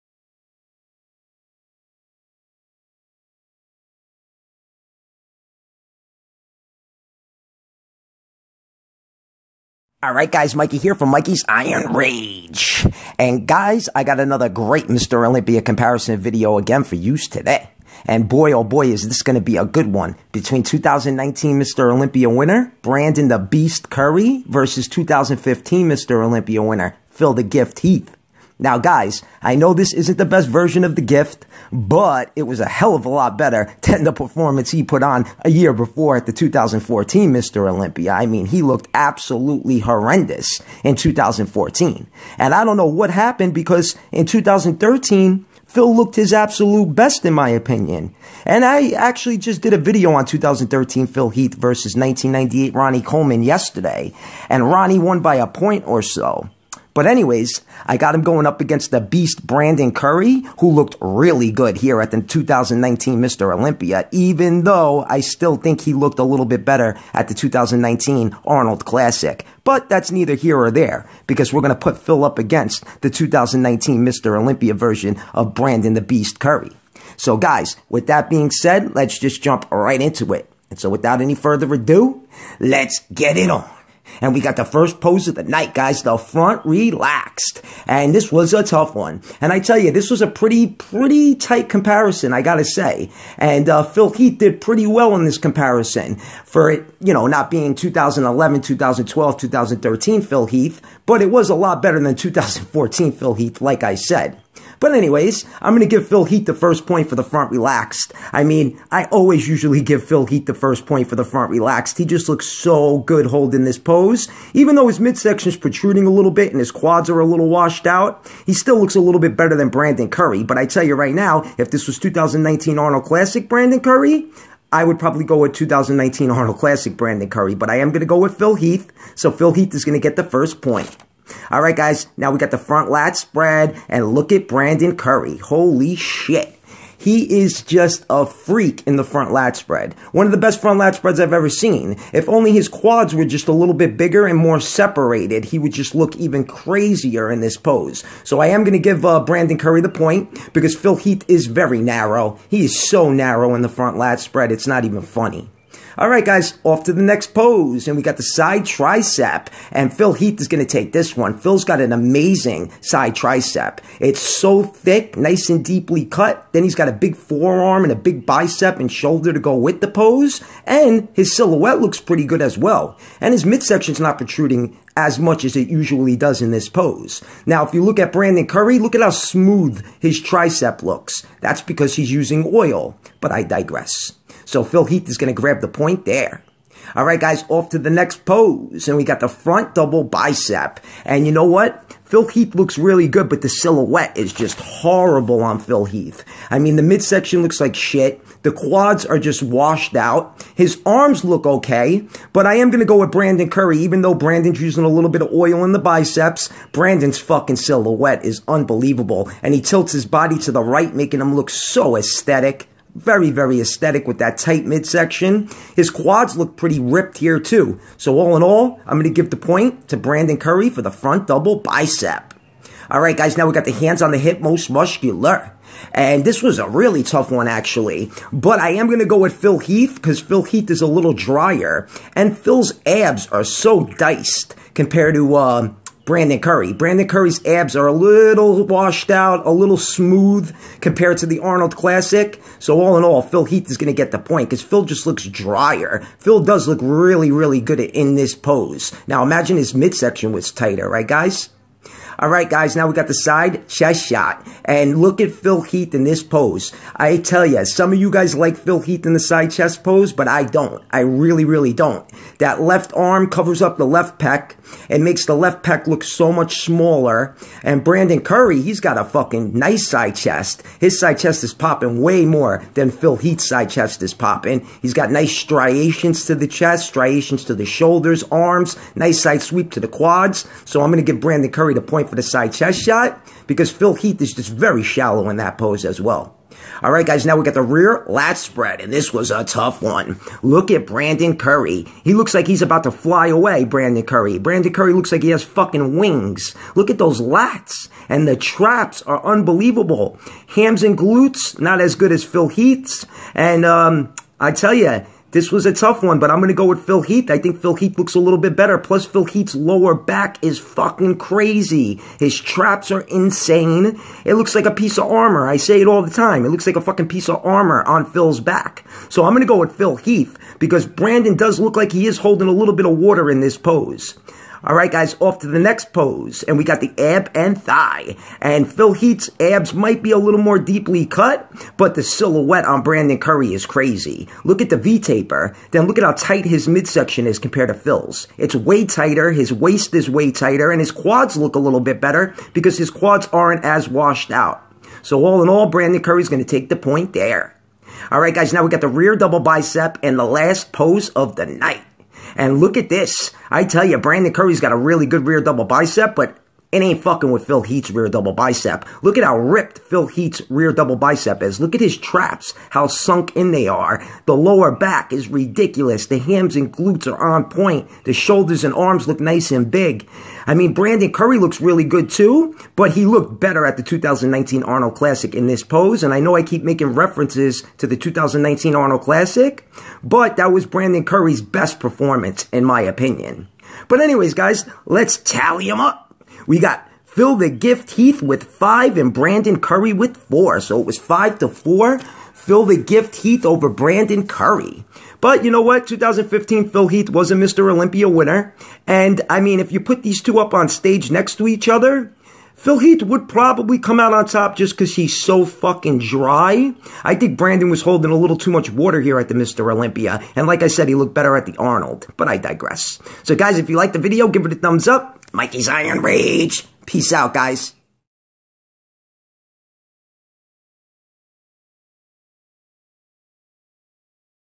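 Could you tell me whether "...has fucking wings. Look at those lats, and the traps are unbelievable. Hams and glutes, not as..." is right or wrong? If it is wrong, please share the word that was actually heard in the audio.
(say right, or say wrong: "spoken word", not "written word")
right.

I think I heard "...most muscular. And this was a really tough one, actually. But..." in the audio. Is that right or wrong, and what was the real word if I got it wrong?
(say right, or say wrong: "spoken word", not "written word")
right.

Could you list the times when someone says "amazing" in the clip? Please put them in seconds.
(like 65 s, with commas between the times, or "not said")
161 s.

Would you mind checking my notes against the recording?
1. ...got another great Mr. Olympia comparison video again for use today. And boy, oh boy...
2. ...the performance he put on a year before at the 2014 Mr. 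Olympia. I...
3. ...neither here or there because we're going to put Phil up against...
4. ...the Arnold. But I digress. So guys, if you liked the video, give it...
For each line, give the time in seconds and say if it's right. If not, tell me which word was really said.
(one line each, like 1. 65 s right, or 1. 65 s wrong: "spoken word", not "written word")
1. 14 s right
2. 34 s right
3. 70 s right
4. 411 s right.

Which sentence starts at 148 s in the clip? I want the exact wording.
So I am going to give uh, Brandon Curry the point because Phil Heath is very narrow.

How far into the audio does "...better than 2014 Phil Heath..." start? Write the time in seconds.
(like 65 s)
101 s.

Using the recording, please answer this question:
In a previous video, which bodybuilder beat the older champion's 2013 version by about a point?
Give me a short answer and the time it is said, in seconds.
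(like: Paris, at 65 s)
Ronnie Coleman, at 52 s.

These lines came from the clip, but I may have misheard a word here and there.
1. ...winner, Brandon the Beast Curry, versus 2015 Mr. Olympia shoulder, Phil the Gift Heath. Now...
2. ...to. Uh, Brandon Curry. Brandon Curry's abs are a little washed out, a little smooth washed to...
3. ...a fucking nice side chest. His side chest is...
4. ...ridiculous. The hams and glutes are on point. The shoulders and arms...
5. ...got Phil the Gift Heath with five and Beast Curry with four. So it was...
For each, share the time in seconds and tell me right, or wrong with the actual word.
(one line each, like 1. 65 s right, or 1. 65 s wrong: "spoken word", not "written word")
1. 22 s wrong: "winner", not "shoulder"
2. 235 s wrong: "compared", not "washed"
3. 268 s right
4. 365 s right
5. 386 s wrong: "Brandon", not "Beast".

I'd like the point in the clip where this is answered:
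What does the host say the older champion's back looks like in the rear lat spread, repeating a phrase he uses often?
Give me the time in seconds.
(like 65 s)
314 s.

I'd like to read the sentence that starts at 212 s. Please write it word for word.
Very, very aesthetic with that tight midsection.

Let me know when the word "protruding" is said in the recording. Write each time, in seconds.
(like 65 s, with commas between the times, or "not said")
115 s, 174 s.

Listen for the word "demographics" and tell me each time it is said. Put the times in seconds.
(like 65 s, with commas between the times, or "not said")
not said.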